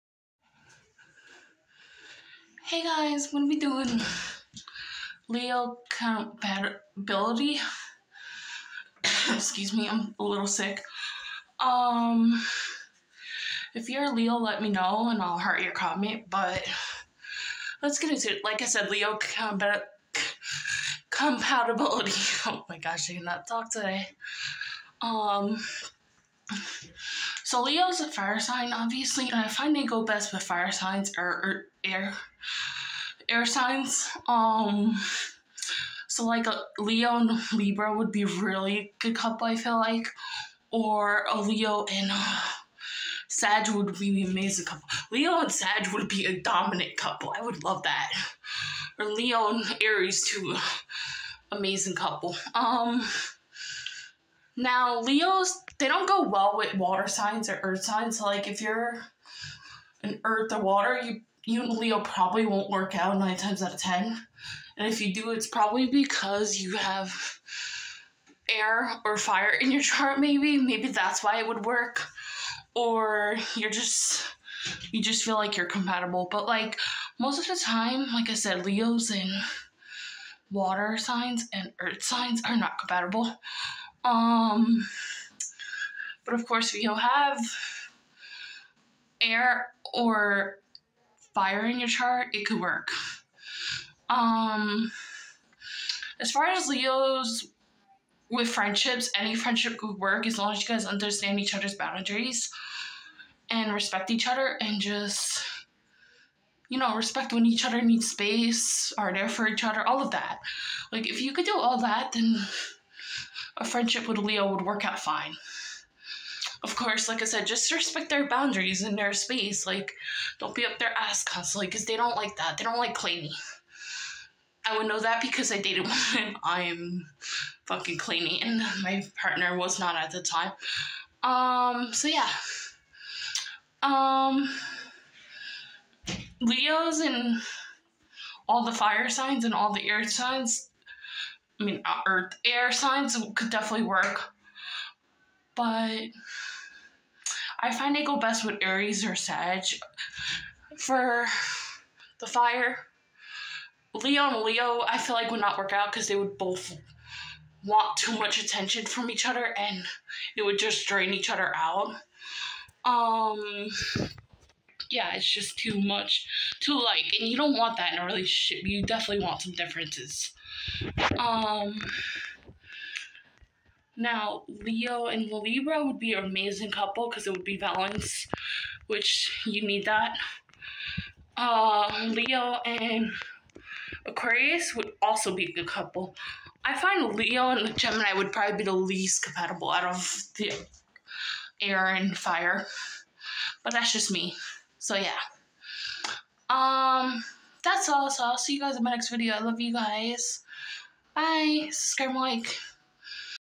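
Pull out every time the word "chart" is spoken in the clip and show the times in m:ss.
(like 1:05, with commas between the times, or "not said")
1:09, 1:31.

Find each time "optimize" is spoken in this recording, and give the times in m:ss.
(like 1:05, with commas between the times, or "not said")
not said.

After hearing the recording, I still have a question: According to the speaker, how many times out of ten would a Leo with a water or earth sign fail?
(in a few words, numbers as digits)
9.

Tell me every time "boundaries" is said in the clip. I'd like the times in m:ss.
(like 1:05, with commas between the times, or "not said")
1:41, 1:58.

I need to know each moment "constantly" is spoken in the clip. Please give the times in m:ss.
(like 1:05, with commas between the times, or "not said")
2:01.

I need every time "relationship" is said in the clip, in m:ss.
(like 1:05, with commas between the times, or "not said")
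2:48.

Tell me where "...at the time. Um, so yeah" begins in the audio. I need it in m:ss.
2:09.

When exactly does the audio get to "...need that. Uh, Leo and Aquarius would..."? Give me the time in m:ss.
2:59.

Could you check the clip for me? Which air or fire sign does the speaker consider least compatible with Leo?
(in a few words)
Gemini.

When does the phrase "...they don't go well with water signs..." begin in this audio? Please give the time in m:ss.
0:55.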